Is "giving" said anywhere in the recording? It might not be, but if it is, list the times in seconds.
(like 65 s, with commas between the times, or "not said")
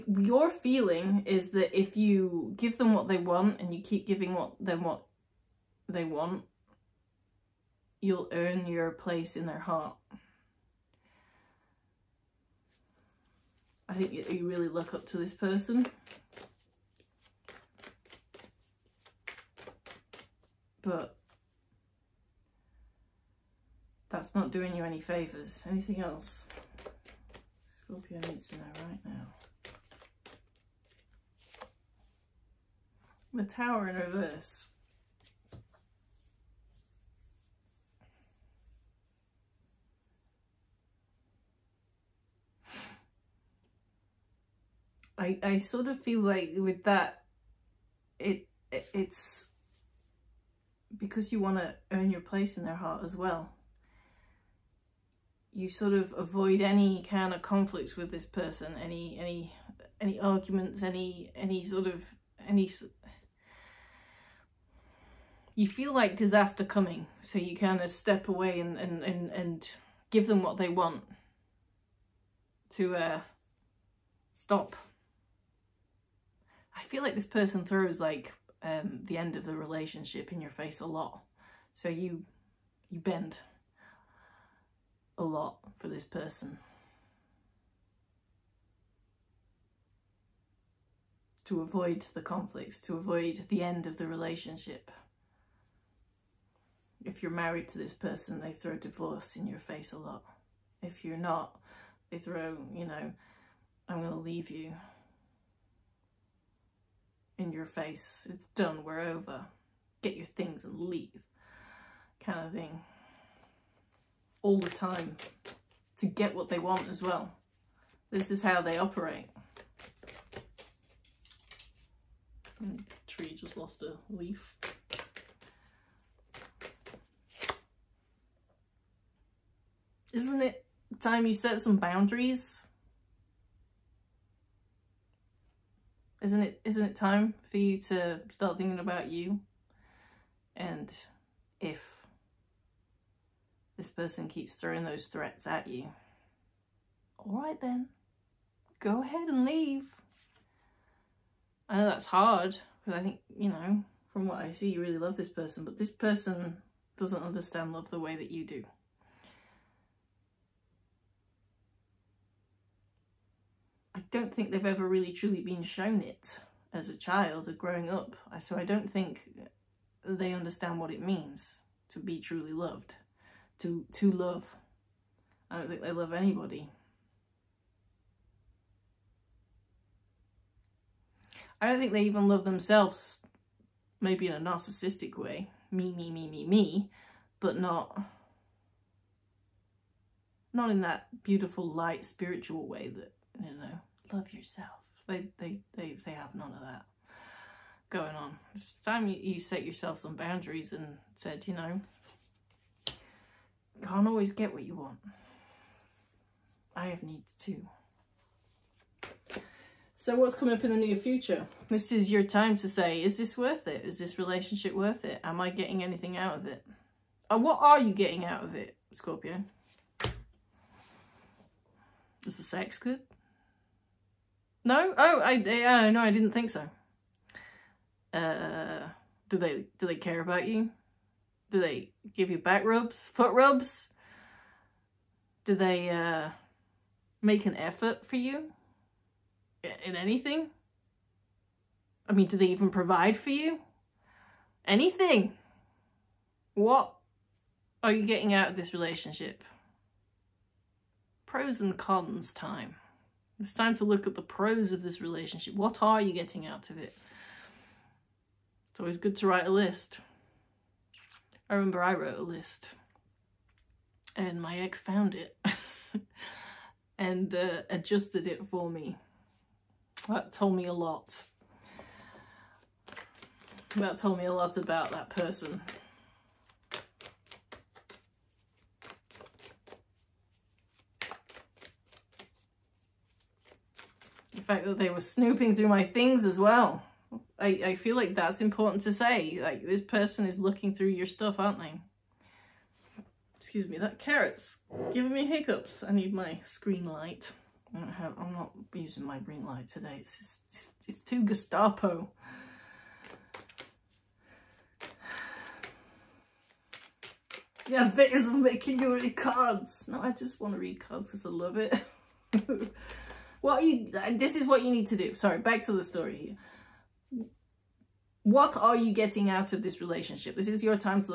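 4 s, 294 s.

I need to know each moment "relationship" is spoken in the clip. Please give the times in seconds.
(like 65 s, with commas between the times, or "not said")
79 s, 94 s, 214 s, 248 s, 255 s, 319 s.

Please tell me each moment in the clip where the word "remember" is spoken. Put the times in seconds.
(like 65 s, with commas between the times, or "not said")
261 s.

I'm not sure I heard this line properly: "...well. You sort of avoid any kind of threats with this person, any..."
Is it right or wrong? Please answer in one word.
wrong.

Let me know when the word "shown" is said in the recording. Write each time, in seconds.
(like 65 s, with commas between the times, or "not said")
165 s.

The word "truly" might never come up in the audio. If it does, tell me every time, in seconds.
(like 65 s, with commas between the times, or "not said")
165 s, 172 s.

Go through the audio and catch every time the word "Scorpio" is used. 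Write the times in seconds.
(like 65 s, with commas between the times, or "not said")
27 s, 218 s.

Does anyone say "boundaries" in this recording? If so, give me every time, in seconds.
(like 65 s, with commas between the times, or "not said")
131 s, 200 s.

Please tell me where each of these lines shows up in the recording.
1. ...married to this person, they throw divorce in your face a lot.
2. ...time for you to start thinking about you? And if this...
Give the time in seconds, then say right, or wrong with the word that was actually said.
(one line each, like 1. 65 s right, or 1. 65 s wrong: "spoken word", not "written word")
1. 97 s right
2. 136 s right.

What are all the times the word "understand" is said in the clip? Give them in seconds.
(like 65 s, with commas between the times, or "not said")
157 s, 170 s.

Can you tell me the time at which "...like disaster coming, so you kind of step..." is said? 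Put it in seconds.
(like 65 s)
65 s.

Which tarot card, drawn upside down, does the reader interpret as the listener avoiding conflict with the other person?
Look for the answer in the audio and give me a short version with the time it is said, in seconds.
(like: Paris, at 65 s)
The Tower, at 33 s.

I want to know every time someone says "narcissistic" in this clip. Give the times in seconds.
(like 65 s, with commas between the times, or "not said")
184 s.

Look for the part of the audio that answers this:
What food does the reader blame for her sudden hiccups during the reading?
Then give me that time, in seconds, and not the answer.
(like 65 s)
293 s.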